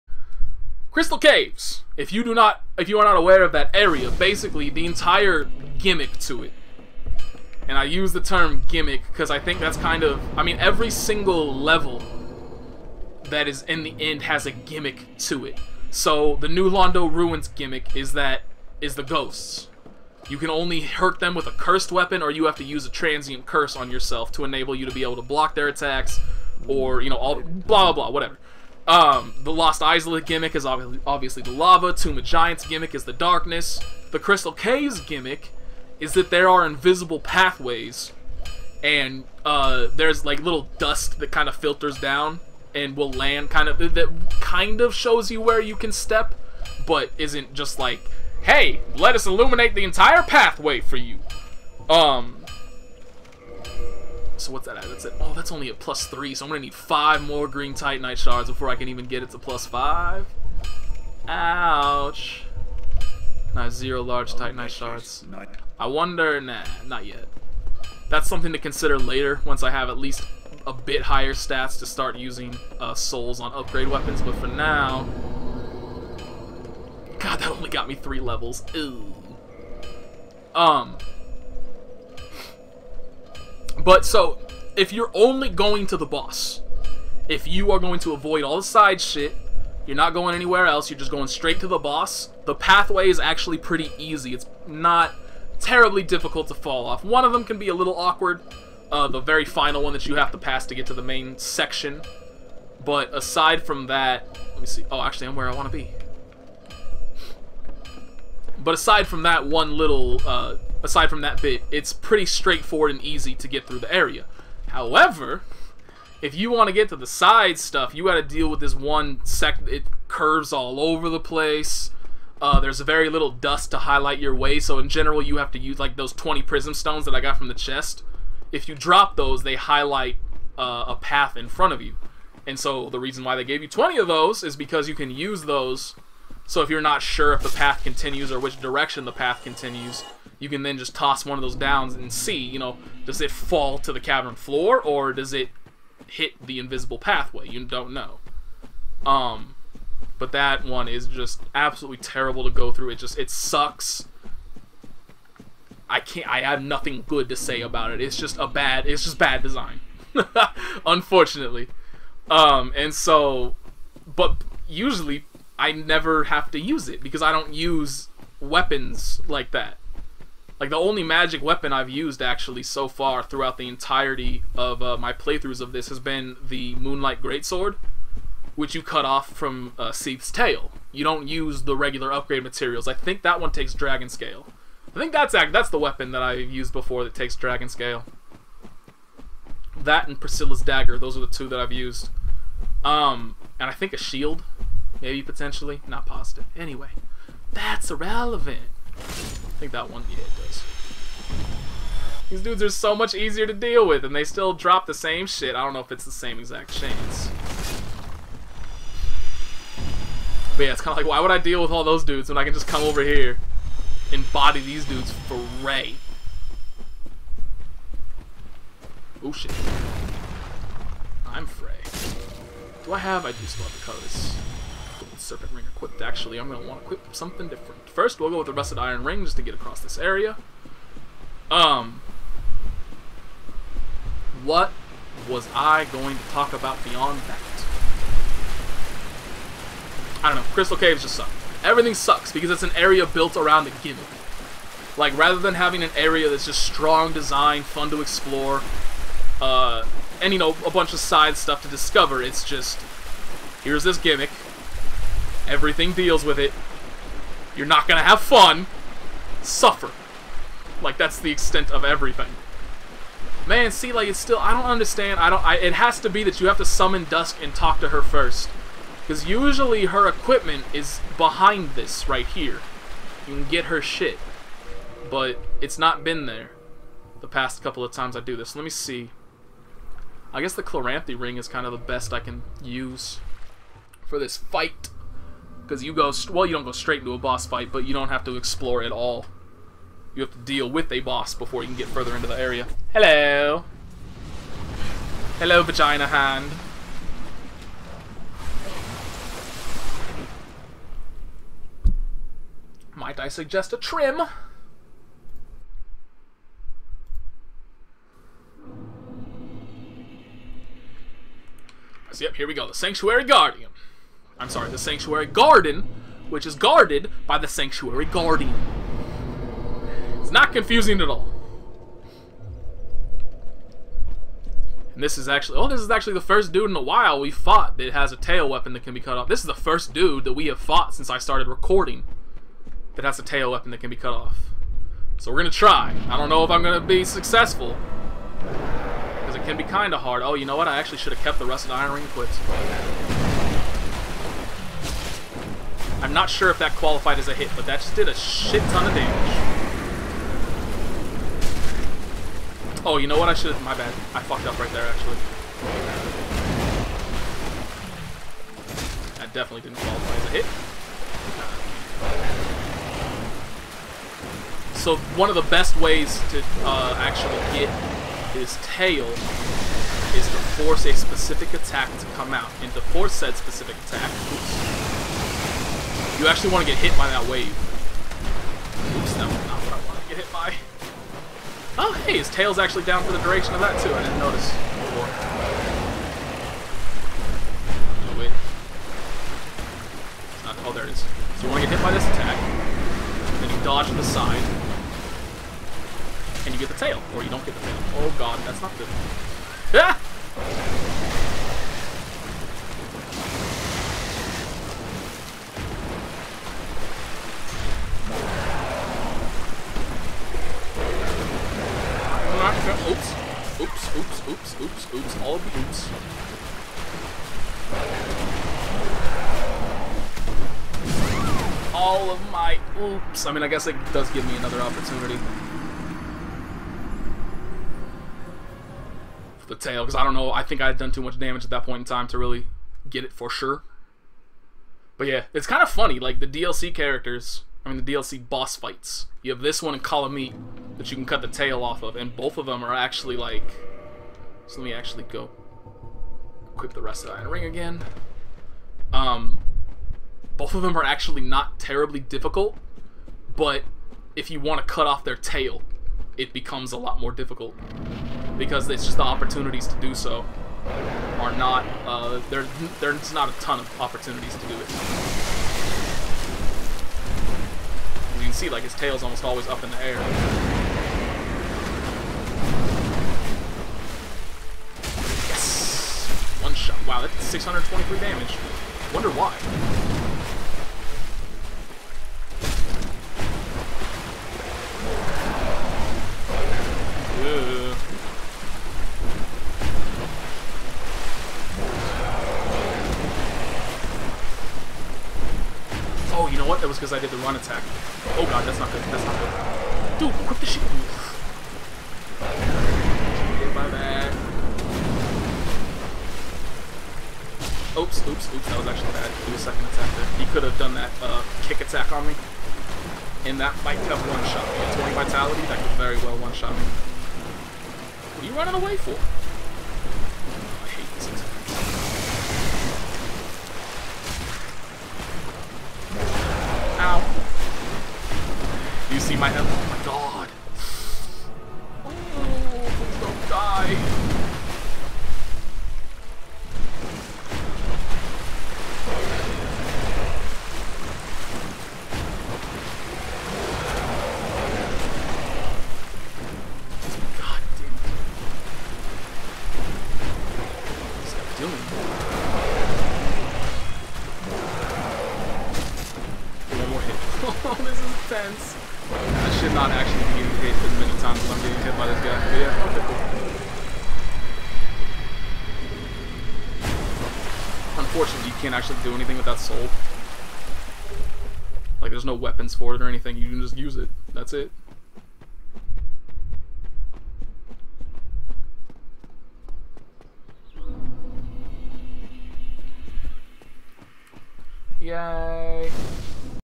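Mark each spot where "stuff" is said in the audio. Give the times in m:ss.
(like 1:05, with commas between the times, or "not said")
1:57, 4:11.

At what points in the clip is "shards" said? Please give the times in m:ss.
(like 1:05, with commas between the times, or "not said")
0:58, 1:04.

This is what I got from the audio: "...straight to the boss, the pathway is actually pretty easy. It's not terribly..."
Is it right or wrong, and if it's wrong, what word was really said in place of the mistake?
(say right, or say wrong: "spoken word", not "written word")
right.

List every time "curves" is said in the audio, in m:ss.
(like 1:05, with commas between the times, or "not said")
2:00.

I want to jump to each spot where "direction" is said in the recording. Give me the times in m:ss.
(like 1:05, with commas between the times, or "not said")
2:18.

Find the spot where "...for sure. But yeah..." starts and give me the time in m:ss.
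7:13.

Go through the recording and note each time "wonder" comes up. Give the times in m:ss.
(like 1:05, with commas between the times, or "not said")
1:05, 7:58.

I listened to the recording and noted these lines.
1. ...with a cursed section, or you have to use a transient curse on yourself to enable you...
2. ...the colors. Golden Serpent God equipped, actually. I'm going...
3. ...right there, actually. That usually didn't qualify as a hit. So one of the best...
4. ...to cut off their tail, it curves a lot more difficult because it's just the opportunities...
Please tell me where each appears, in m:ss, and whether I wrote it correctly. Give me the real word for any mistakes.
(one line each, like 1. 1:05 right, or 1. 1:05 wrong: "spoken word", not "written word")
1. 0:21 wrong: "weapon", not "section"
2. 3:43 wrong: "Ring", not "God"
3. 5:54 wrong: "definitely", not "usually"
4. 7:34 wrong: "becomes", not "curves".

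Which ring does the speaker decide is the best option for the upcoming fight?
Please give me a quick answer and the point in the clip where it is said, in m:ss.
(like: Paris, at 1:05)
Chloranthy ring, at 4:40.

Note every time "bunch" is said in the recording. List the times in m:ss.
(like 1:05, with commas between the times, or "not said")
4:10.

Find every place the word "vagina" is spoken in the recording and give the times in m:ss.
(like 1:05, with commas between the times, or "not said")
4:55.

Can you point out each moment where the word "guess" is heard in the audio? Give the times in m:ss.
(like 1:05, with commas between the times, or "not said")
4:40, 7:03.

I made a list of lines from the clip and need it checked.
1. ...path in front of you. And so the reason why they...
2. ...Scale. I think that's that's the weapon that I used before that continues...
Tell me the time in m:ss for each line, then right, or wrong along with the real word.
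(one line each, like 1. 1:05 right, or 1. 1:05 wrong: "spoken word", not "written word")
1. 2:10 right
2. 3:04 wrong: "takes", not "continues".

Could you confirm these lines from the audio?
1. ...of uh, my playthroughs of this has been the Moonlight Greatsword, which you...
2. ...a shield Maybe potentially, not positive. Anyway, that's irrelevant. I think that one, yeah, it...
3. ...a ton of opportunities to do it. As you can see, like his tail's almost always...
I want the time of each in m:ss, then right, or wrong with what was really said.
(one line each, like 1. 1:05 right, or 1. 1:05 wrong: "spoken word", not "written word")
1. 2:54 right
2. 3:13 right
3. 7:43 right.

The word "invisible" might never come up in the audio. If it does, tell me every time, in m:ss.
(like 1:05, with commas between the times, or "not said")
0:36, 2:26.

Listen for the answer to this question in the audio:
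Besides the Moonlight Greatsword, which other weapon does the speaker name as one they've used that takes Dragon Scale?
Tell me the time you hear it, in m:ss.
3:10.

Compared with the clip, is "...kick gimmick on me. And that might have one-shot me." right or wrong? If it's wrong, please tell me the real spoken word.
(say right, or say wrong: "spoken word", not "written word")
wrong: "attack", not "gimmick".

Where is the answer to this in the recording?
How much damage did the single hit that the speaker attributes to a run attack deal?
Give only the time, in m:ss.
7:57.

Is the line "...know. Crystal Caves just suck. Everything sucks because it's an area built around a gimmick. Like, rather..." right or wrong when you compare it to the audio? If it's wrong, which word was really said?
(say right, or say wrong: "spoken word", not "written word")
right.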